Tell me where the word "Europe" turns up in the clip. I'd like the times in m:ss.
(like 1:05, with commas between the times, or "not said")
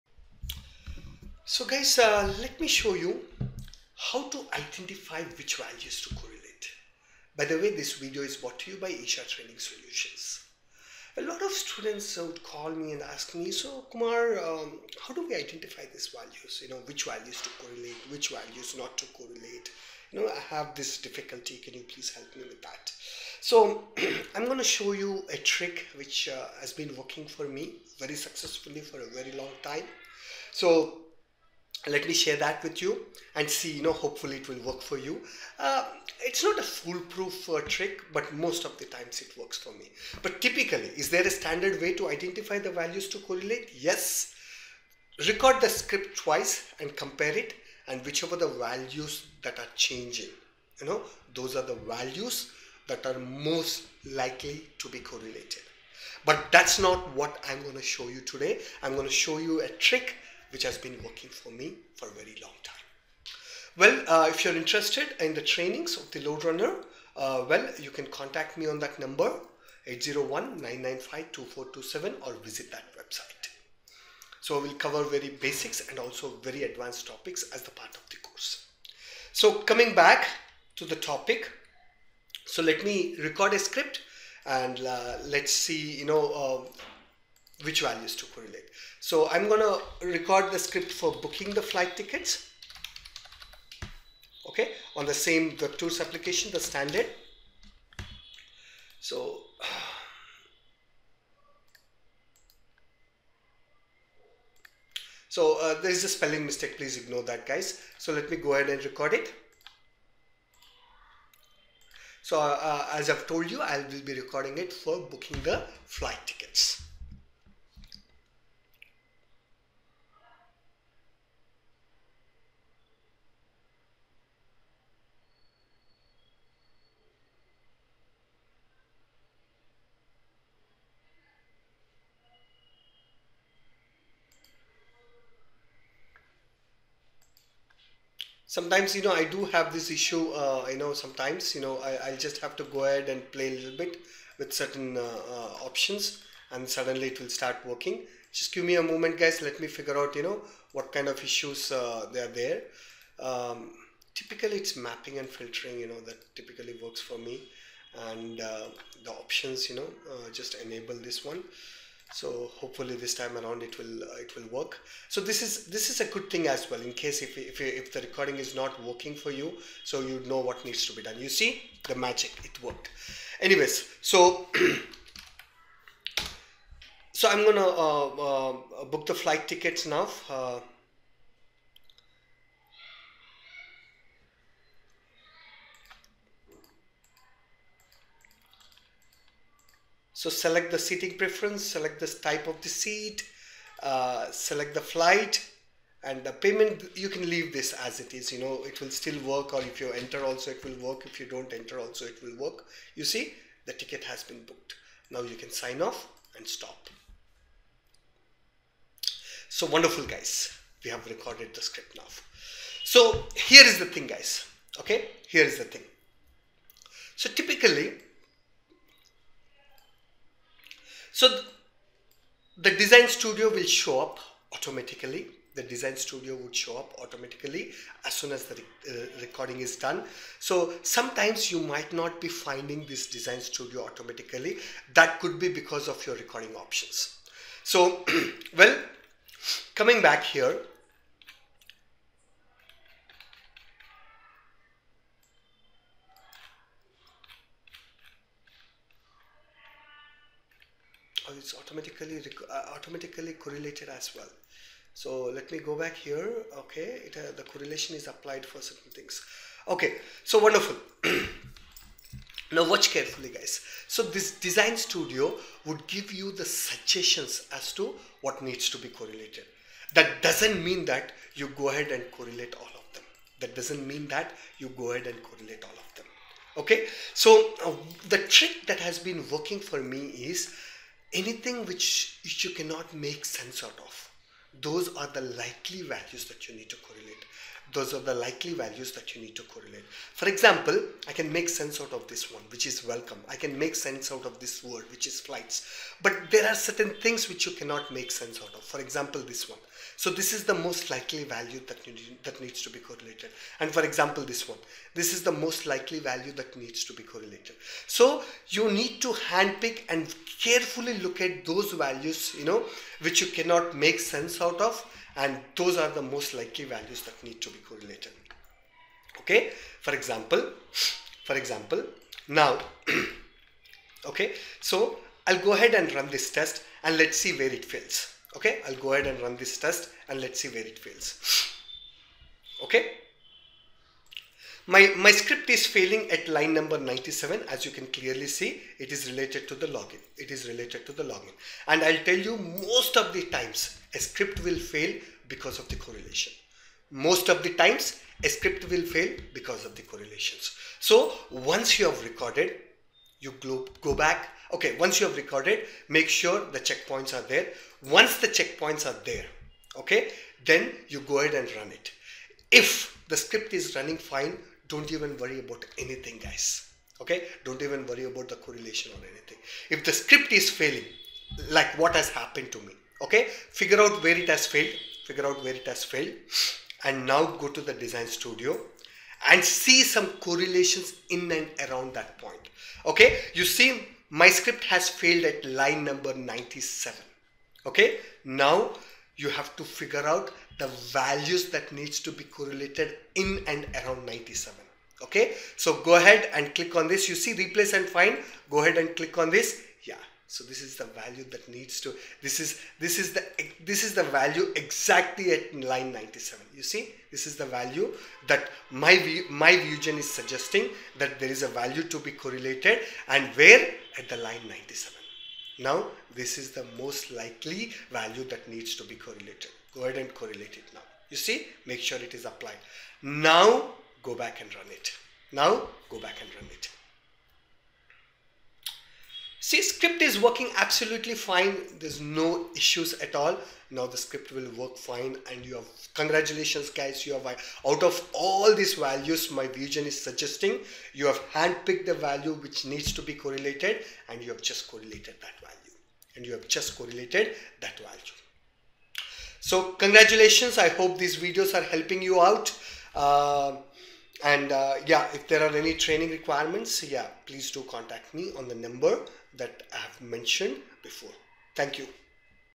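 not said.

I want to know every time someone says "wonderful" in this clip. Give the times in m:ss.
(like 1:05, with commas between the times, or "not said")
3:29, 4:20.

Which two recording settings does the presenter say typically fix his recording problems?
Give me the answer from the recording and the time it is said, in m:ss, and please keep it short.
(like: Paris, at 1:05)
Mapping and filtering, at 2:34.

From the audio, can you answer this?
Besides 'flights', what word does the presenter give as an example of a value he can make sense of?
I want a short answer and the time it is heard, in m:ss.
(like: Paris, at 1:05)
Welcome, at 4:52.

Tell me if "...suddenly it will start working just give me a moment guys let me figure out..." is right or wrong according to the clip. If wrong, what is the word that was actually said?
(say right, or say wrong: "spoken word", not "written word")
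right.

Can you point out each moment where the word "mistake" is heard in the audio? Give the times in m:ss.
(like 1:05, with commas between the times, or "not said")
1:46.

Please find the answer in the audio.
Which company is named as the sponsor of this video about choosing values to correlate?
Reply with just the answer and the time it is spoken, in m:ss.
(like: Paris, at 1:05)
Isha Training Solutions, at 0:08.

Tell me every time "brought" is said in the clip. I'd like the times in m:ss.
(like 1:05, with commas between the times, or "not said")
0:08.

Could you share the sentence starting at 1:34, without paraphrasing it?
Okay, on the same the tours application, the standard.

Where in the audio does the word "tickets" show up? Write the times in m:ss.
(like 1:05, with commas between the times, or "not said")
1:31, 1:56, 2:59, 3:23.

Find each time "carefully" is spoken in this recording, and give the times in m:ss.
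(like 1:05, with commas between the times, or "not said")
4:22, 5:10.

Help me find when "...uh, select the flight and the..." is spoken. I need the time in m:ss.
3:13.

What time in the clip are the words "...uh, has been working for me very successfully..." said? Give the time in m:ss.
0:26.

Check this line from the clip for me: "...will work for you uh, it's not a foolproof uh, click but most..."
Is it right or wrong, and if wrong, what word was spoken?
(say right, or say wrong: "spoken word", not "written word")
wrong: "trick", not "click".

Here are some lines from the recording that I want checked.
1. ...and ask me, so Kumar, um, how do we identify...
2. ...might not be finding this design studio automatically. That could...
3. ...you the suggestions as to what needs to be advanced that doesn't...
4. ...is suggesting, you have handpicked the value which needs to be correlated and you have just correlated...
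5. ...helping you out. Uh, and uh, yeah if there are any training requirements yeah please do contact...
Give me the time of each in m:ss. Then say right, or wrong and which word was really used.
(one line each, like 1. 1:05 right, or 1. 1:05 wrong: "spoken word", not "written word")
1. 0:12 right
2. 3:51 right
3. 4:26 wrong: "correlated", not "advanced"
4. 7:19 right
5. 7:31 right.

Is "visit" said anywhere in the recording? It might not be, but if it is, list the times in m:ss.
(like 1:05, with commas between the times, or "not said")
1:12.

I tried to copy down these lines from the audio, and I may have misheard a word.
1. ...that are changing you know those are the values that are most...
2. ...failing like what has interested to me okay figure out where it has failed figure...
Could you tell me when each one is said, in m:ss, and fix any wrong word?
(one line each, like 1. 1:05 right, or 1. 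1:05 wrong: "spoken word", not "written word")
1. 0:49 right
2. 6:10 wrong: "happened", not "interested".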